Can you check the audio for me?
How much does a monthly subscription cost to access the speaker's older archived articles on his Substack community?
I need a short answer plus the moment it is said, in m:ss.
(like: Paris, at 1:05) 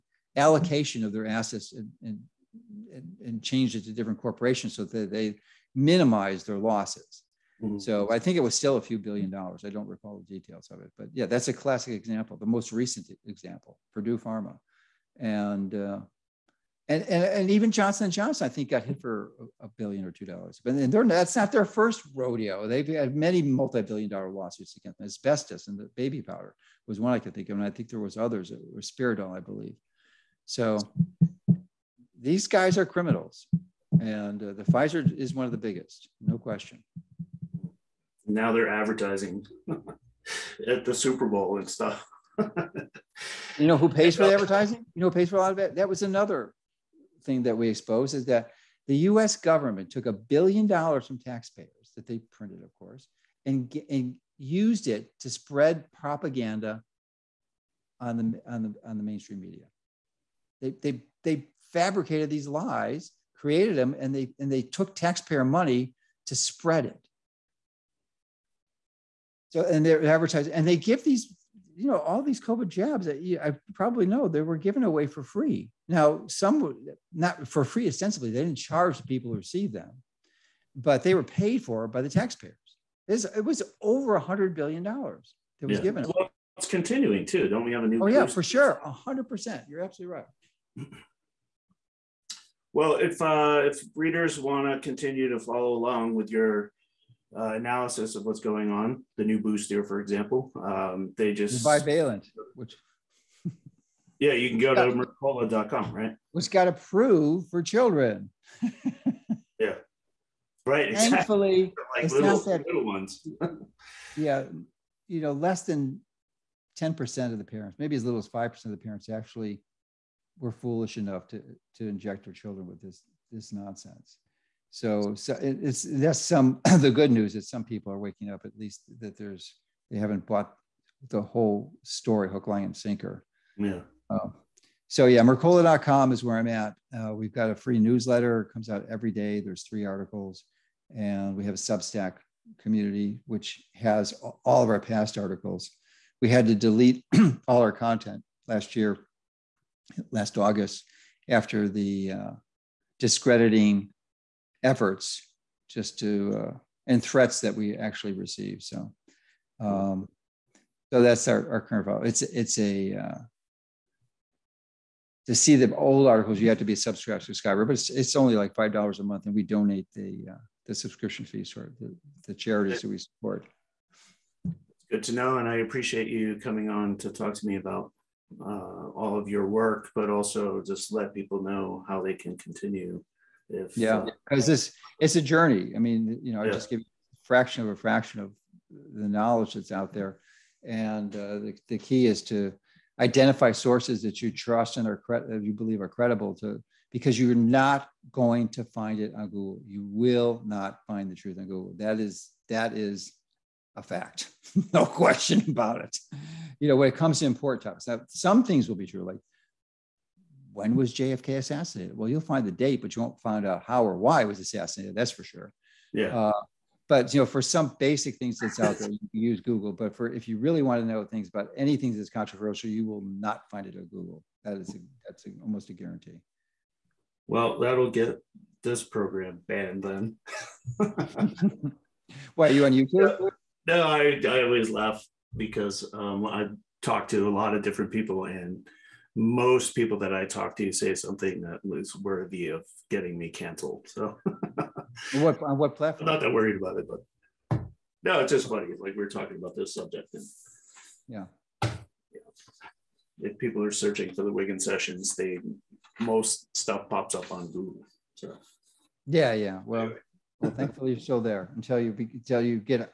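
$5 a month, at 2:48.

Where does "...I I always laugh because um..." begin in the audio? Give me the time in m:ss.
3:53.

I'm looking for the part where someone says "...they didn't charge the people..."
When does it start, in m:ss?
1:18.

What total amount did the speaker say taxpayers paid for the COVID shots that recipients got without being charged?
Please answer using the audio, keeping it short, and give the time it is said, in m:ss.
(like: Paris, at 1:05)
over $100 billion, at 1:23.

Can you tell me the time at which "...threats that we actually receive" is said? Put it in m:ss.
2:37.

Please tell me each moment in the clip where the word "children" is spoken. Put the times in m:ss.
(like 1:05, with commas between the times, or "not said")
1:47, 2:02.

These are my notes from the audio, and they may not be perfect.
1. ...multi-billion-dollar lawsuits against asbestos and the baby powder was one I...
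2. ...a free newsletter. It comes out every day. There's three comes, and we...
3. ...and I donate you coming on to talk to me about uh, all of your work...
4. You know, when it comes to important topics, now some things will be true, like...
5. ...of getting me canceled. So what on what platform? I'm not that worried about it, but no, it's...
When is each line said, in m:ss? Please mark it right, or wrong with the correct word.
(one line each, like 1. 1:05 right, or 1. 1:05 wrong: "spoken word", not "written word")
1. 0:23 right
2. 2:17 wrong: "articles", not "comes"
3. 2:55 wrong: "appreciate", not "donate"
4. 3:26 right
5. 4:02 right.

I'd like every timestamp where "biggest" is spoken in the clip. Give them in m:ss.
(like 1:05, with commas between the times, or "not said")
0:35.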